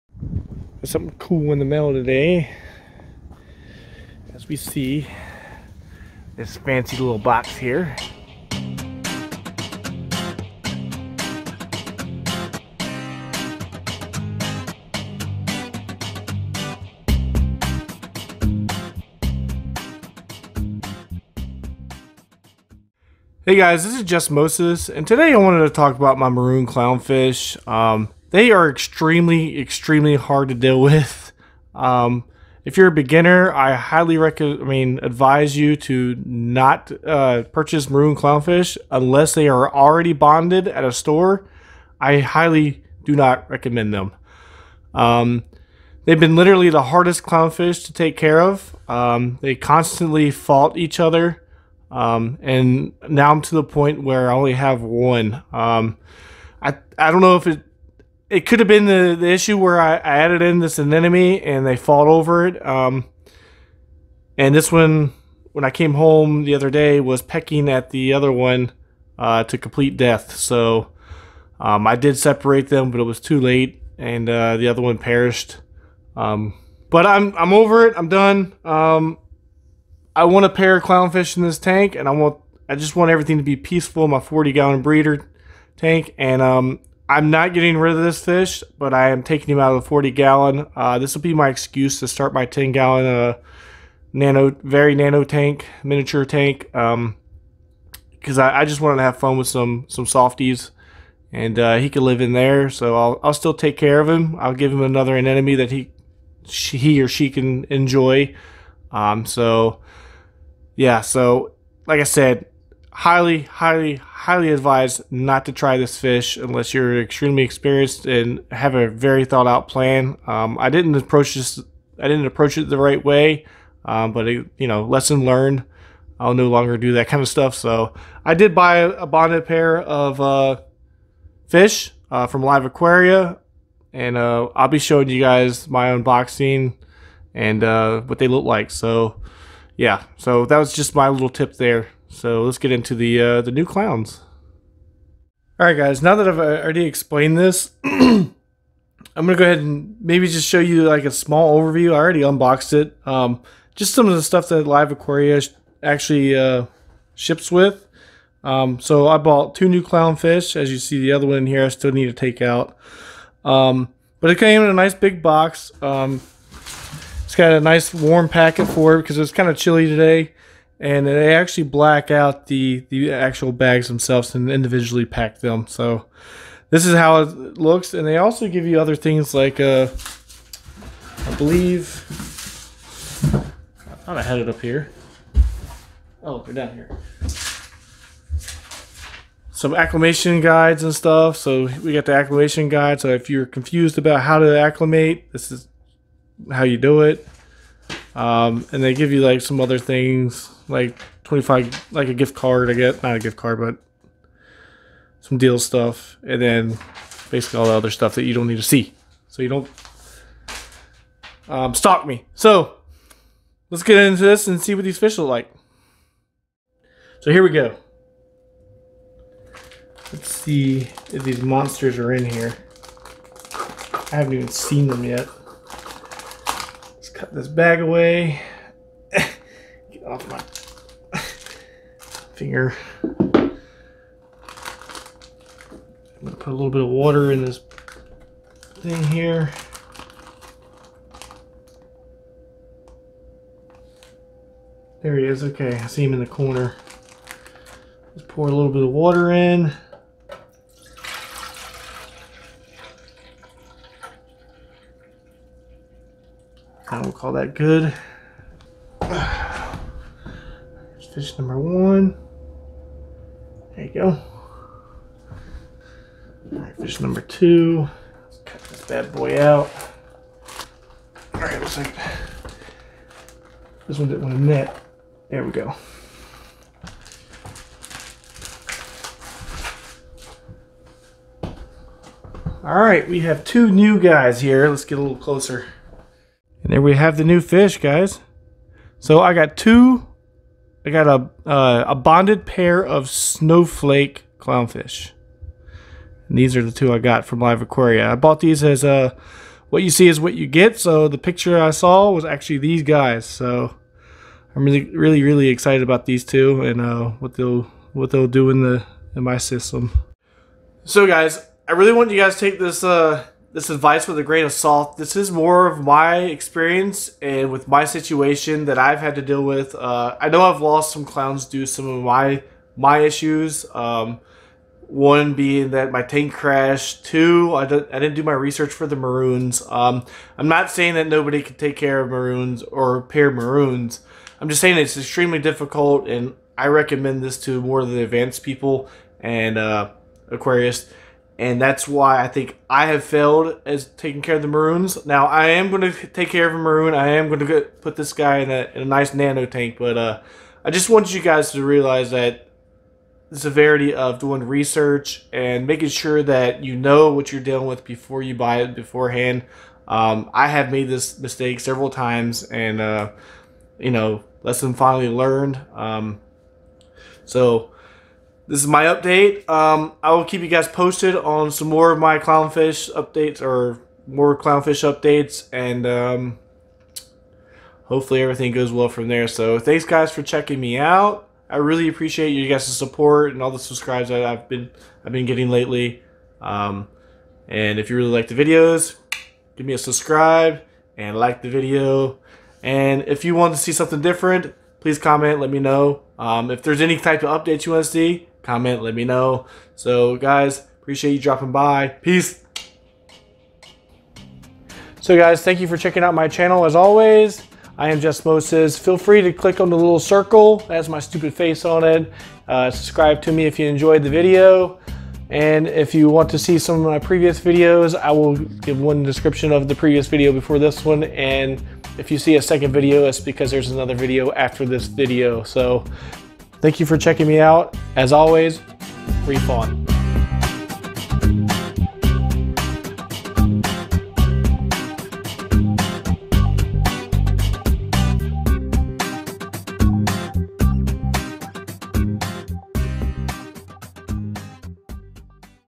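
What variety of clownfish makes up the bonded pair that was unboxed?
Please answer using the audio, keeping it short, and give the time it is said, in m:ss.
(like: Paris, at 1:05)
Snowflake clownfish, at 4:53.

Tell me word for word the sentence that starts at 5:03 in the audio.
So I'm really, really, really excited about these two and uh, what they'll, what they'll do in the, in my system.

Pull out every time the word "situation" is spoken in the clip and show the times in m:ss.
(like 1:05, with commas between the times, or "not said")
5:17.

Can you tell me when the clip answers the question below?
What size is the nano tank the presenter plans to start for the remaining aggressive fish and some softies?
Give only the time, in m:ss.
1:32.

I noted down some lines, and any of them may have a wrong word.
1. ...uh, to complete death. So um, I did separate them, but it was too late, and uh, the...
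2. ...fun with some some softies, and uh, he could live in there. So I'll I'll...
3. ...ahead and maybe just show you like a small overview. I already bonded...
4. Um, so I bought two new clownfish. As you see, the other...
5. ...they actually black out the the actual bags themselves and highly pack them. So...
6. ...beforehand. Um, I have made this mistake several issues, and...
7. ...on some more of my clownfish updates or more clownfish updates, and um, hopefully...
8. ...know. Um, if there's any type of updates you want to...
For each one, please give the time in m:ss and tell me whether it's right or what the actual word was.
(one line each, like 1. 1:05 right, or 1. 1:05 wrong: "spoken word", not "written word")
1. 1:09 right
2. 1:39 right
3. 2:29 wrong: "unboxed", not "bonded"
4. 2:38 right
5. 2:51 wrong: "individually", not "highly"
6. 5:58 wrong: "times", not "issues"
7. 6:11 right
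8. 6:35 right.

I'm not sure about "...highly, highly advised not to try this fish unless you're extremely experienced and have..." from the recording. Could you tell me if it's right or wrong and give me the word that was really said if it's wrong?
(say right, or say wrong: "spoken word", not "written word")
right.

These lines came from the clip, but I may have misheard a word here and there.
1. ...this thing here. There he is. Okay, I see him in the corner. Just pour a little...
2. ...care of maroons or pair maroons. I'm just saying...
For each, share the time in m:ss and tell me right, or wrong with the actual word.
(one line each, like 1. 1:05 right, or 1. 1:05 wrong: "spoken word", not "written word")
1. 3:57 right
2. 5:31 right.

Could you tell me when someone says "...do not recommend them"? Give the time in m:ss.
0:43.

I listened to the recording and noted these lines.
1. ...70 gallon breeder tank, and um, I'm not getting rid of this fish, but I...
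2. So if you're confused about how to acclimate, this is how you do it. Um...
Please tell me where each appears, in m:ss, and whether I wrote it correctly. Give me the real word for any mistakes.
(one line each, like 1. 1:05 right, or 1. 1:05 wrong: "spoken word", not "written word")
1. 1:24 wrong: "40", not "70"
2. 3:12 right.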